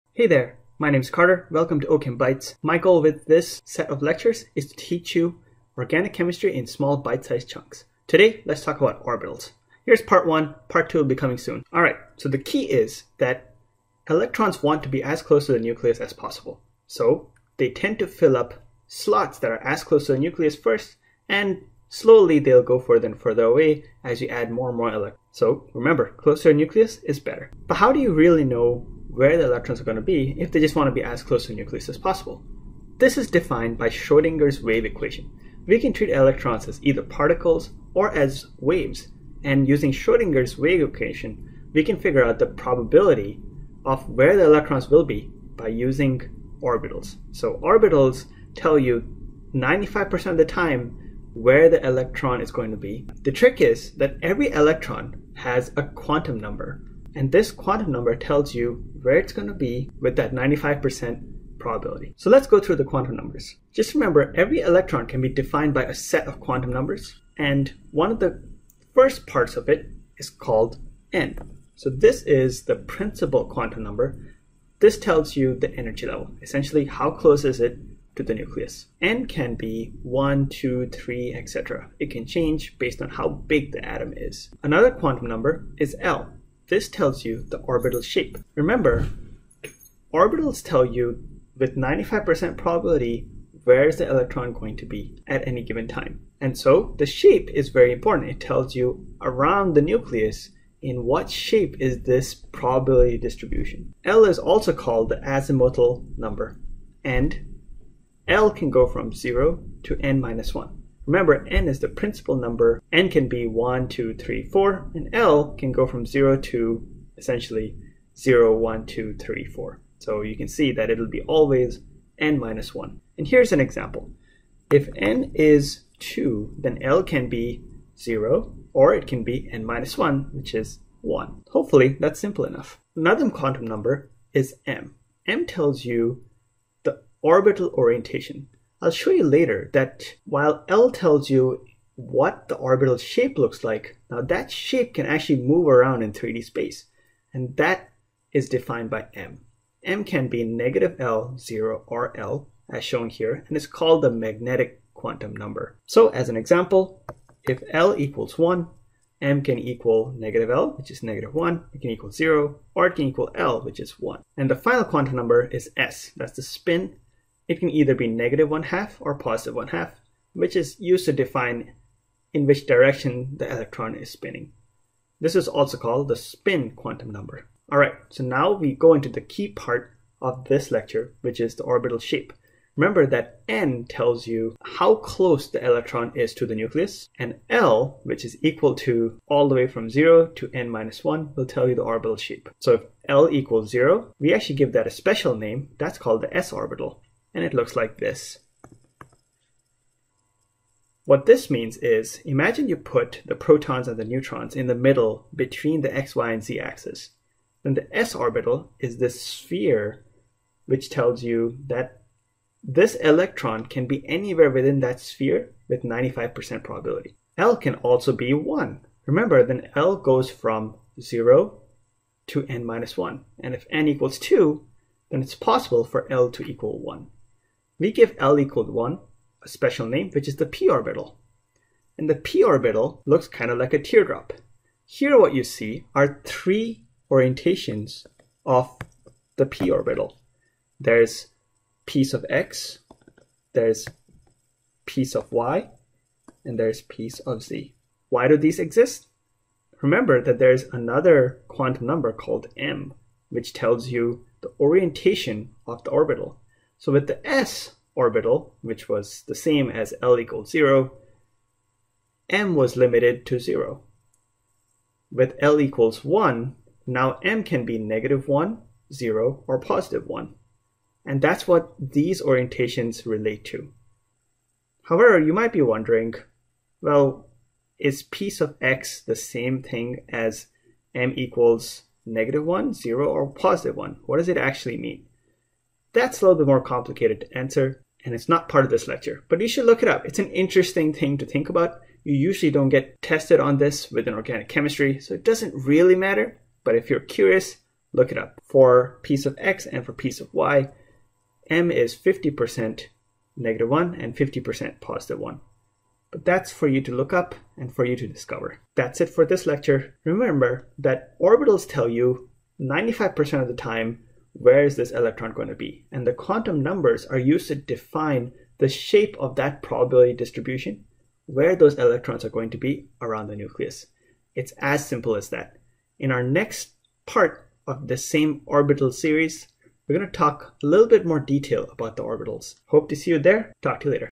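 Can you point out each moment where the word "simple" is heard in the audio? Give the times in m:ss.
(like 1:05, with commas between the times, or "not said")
2:12, 5:24.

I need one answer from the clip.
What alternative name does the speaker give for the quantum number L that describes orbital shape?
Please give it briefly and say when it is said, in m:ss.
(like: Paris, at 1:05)
azimuthal number, at 1:45.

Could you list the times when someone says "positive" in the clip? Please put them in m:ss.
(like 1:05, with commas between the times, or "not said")
2:49, 4:29, 4:43, 5:04.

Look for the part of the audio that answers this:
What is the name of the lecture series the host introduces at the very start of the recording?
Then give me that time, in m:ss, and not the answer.
0:01.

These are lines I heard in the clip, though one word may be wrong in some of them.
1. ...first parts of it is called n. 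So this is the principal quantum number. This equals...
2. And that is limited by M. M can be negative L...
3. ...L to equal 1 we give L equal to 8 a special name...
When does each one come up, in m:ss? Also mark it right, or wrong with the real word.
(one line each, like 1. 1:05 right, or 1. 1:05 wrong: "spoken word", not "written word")
1. 1:08 wrong: "tells", not "equals"
2. 2:27 wrong: "defined", not "limited"
3. 3:46 wrong: "1", not "8".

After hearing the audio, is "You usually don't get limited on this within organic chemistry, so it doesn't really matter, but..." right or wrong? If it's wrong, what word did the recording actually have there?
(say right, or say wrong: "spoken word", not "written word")
wrong: "tested", not "limited".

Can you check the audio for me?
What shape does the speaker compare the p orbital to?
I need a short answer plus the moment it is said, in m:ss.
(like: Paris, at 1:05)
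a teardrop, at 3:53.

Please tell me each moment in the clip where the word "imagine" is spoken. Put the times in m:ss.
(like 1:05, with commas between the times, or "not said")
3:22.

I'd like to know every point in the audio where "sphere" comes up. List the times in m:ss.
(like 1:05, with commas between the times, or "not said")
3:29, 3:34.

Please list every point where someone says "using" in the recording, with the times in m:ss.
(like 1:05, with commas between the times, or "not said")
0:39, 0:45.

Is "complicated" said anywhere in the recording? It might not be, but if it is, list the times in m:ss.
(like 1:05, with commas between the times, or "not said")
4:46.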